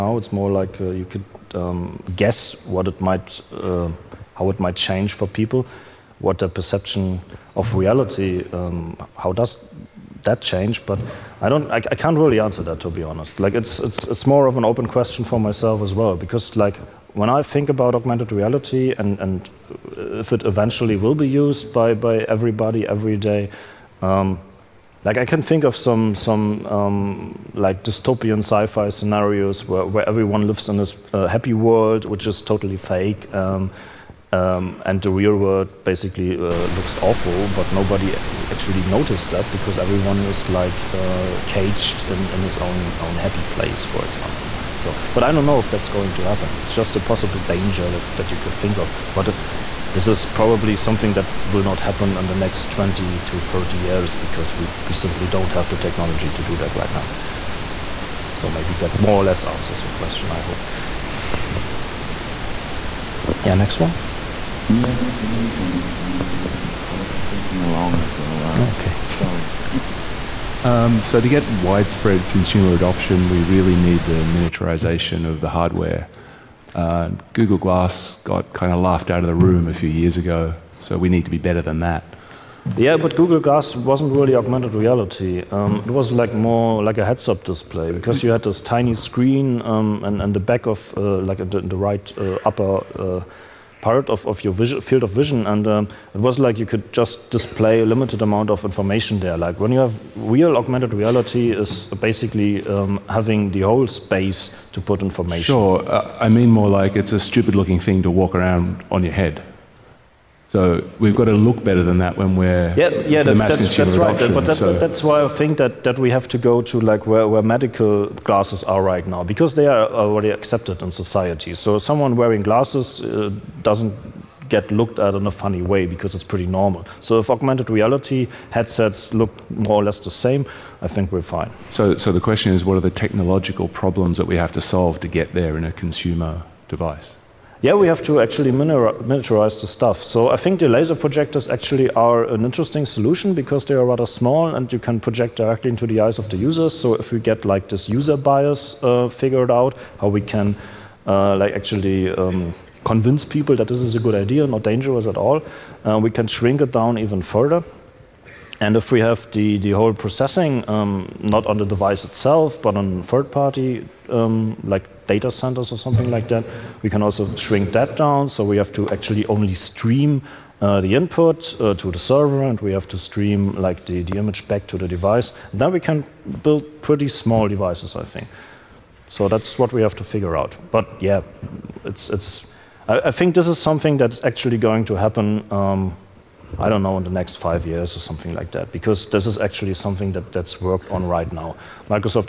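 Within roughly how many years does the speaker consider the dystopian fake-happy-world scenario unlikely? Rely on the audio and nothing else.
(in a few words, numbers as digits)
20 to 30 years.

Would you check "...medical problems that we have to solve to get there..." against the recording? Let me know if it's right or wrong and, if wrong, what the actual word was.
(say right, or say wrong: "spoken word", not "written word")
wrong: "technological", not "medical".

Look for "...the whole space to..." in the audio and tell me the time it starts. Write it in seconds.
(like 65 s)
103 s.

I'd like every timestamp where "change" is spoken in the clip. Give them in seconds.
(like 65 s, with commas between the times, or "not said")
4 s, 10 s.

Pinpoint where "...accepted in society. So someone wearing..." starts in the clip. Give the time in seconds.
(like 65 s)
120 s.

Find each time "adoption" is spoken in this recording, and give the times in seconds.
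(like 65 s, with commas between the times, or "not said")
72 s, 114 s.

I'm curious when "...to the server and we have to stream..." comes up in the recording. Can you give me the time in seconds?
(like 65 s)
171 s.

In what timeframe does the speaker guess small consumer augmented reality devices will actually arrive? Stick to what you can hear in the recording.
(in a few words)
next five years.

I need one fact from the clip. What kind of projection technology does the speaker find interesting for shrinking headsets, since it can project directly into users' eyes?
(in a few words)
laser projectors.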